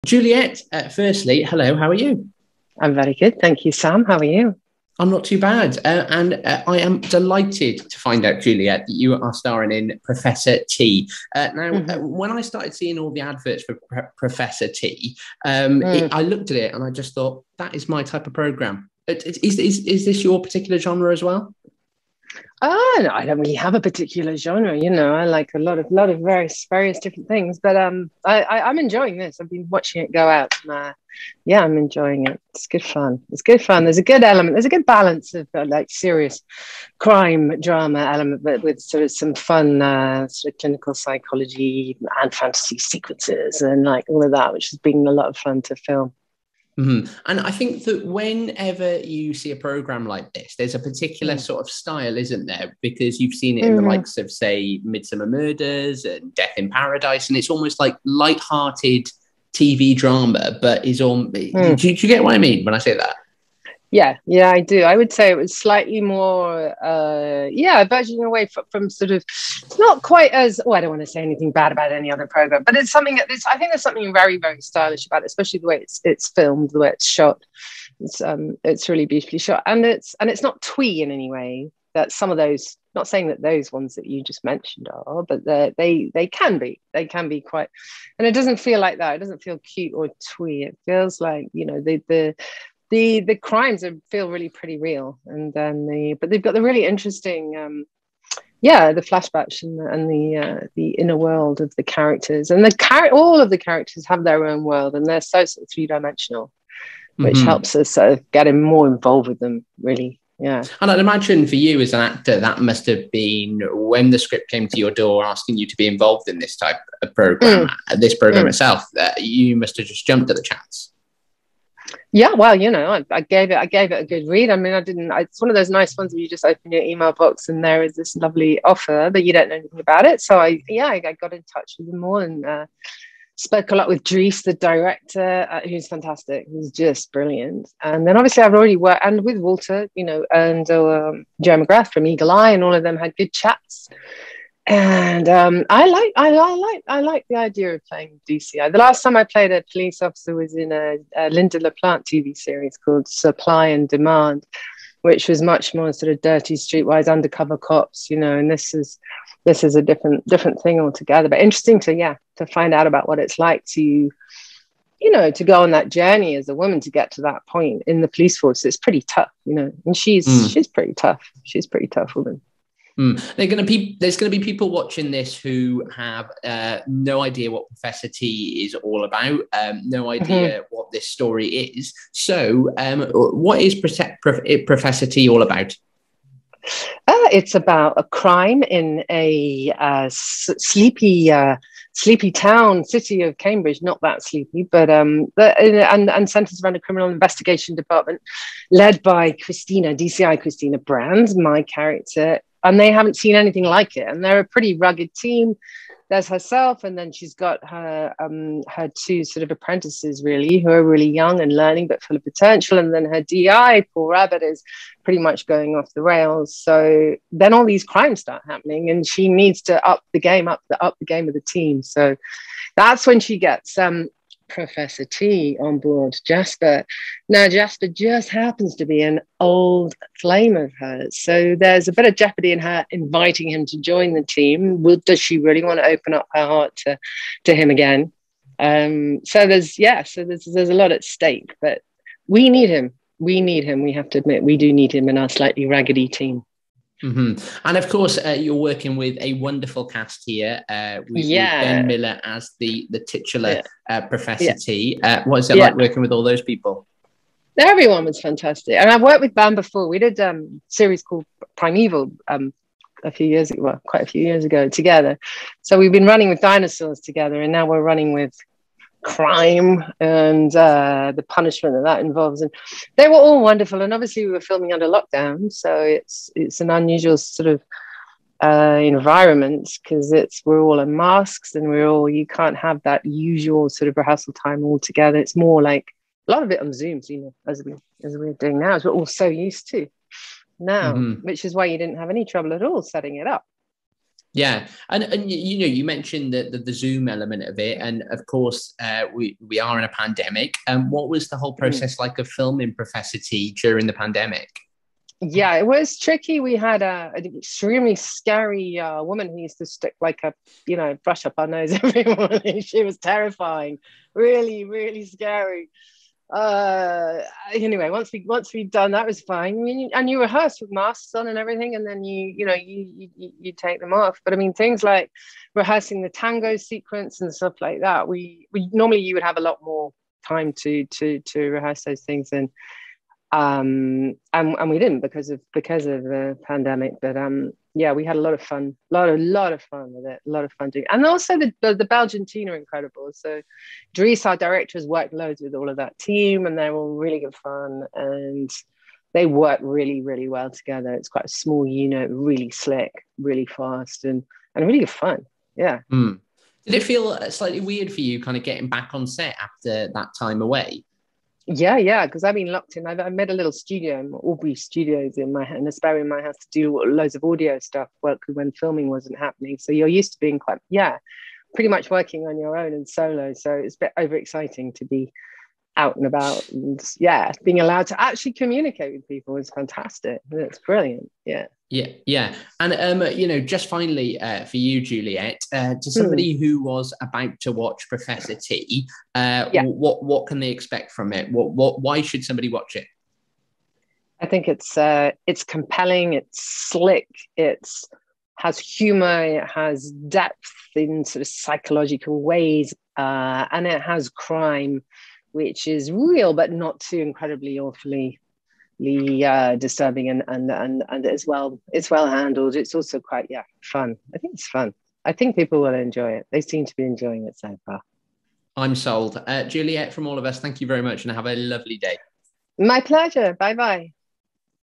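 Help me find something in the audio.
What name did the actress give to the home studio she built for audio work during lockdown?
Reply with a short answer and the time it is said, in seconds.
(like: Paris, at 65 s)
Aubrey Studios, at 364 s.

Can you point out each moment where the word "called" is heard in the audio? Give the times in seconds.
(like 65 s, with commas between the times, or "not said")
152 s, 261 s.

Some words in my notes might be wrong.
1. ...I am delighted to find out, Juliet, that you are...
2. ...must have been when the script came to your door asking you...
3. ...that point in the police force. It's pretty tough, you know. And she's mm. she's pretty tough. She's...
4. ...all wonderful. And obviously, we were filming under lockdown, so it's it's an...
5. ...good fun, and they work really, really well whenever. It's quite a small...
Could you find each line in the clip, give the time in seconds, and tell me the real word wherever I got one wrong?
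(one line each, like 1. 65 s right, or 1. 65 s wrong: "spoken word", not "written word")
1. 6 s right
2. 112 s right
3. 167 s right
4. 273 s right
5. 347 s wrong: "together", not "whenever".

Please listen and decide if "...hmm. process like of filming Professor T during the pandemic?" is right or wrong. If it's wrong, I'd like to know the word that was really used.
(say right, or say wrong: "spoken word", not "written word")
right.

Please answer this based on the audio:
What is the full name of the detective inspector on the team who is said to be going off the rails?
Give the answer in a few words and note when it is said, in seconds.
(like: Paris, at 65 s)
Paul Rabbit, at 213 s.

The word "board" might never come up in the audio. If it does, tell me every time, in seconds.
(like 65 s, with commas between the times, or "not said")
225 s.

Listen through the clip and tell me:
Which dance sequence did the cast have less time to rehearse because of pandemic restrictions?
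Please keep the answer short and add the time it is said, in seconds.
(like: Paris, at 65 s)
Tango, at 326 s.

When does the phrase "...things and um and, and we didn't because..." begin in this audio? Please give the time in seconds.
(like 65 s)
332 s.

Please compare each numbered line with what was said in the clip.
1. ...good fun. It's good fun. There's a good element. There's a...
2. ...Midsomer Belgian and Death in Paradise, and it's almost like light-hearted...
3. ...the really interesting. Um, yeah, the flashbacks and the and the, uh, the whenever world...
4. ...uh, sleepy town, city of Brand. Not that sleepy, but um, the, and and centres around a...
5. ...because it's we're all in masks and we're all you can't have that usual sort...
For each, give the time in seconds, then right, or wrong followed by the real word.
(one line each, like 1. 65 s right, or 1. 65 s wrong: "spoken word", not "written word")
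1. 32 s right
2. 54 s wrong: "Murders", not "Belgian"
3. 96 s wrong: "inner", not "whenever"
4. 191 s wrong: "Cambridge", not "Brand"
5. 279 s right.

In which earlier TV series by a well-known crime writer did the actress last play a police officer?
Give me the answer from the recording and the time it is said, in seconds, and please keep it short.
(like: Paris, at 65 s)
Supply and Demand, at 153 s.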